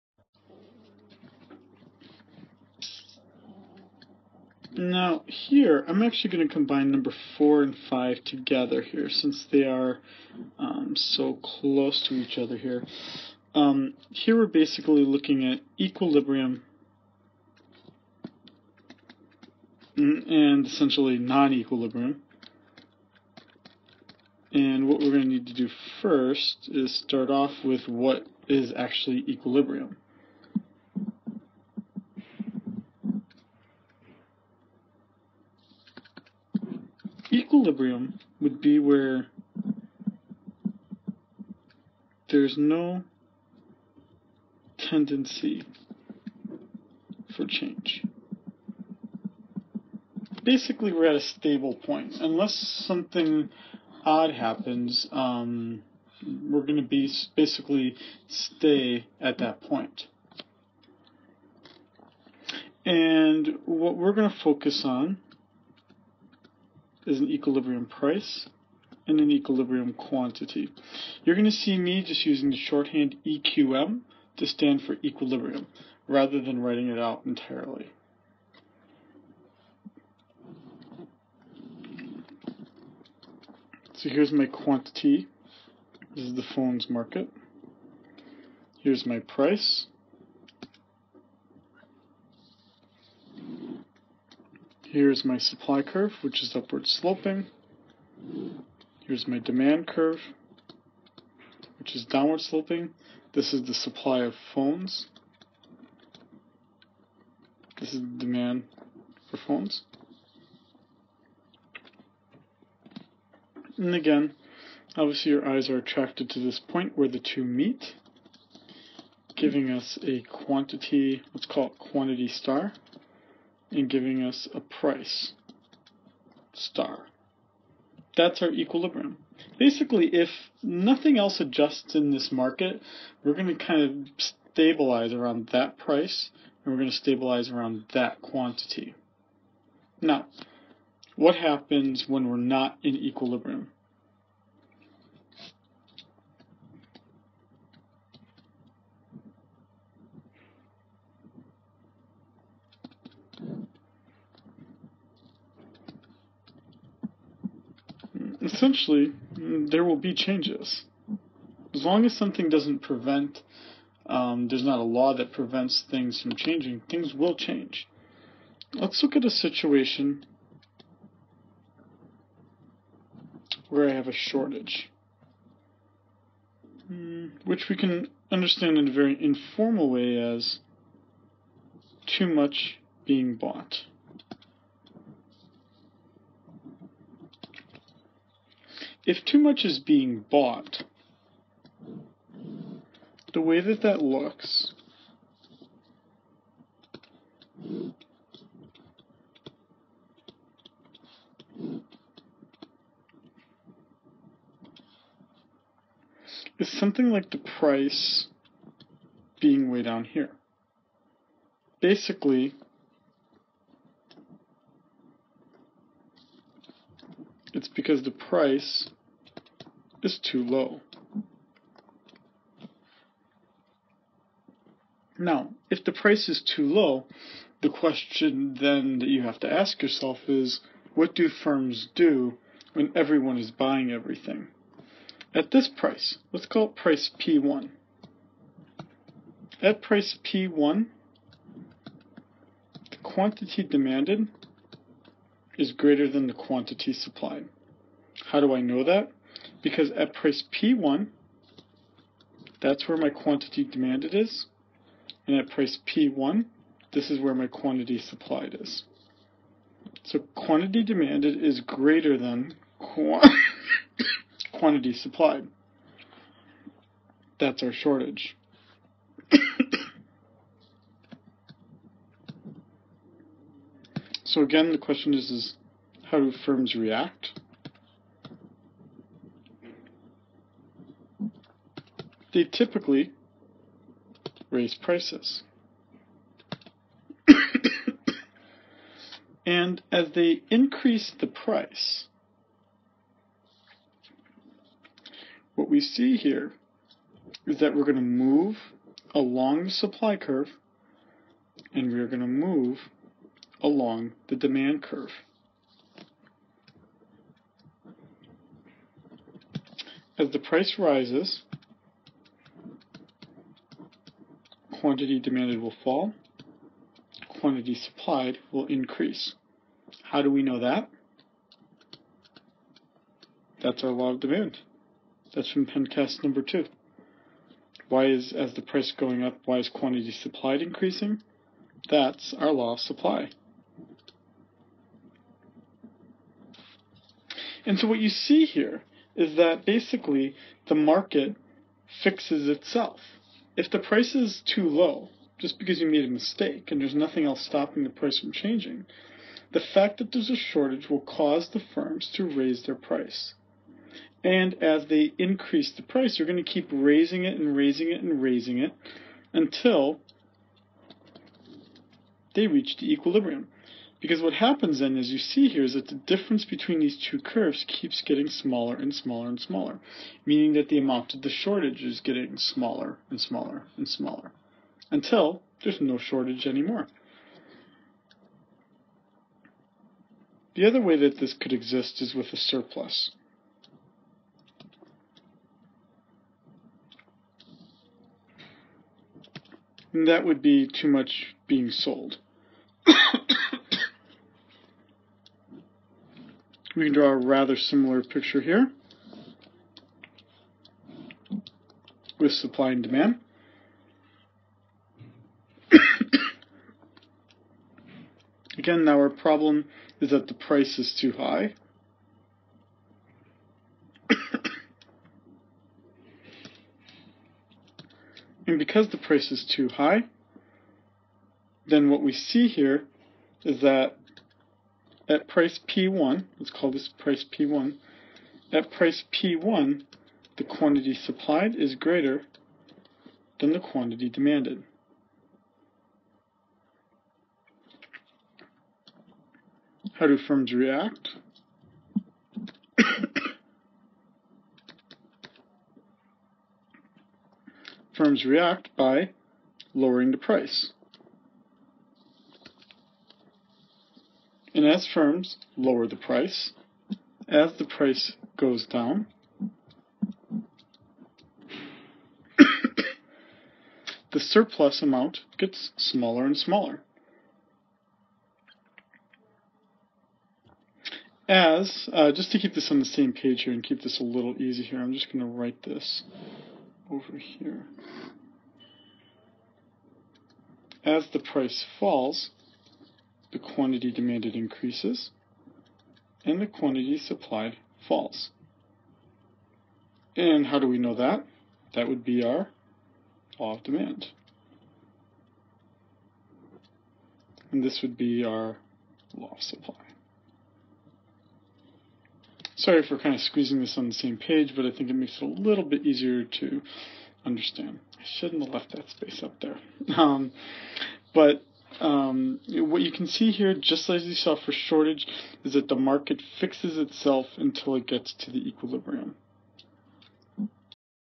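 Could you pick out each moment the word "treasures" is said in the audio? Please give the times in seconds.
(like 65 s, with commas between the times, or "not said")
not said.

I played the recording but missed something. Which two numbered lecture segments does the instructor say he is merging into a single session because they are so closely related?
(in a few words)
4 and 5.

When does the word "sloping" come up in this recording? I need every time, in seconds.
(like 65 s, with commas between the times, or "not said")
96 s, 102 s.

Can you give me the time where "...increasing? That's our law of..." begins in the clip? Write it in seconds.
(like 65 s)
330 s.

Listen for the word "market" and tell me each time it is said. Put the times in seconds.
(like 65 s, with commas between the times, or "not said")
86 s, 132 s, 340 s, 515 s.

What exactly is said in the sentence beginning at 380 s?
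The other way that this could exist is with a surplus.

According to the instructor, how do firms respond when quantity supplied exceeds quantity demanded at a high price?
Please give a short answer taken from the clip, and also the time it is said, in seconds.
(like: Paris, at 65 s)
Lowering the price, at 449 s.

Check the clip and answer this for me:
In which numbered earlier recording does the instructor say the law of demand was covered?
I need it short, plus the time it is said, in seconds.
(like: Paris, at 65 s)
Pencast number 2, at 325 s.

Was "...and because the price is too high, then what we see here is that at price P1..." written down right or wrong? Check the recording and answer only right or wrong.
right.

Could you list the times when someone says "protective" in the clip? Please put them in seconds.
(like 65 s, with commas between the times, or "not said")
not said.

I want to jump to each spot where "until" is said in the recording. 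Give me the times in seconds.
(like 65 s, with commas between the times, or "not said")
359 s, 374 s, 517 s.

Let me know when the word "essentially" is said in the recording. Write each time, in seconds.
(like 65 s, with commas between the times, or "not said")
20 s, 158 s.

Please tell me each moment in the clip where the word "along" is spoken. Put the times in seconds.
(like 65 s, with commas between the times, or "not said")
299 s, 303 s.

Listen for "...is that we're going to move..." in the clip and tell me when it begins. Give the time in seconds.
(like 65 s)
297 s.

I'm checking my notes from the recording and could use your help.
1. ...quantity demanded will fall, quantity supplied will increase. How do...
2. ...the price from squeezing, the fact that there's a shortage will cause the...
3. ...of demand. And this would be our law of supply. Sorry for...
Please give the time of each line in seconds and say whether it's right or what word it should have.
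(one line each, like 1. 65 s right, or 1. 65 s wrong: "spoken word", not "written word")
1. 314 s right
2. 347 s wrong: "changing", not "squeezing"
3. 493 s right.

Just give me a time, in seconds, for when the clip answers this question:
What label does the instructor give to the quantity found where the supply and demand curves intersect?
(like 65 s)
121 s.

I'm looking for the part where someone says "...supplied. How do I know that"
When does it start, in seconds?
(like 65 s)
246 s.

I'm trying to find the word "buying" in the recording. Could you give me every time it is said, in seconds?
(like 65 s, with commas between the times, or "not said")
233 s.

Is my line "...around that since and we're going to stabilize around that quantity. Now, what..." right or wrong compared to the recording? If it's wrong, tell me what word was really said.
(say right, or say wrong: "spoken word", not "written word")
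wrong: "price", not "since".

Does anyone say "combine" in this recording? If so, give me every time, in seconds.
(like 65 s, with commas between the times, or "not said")
6 s.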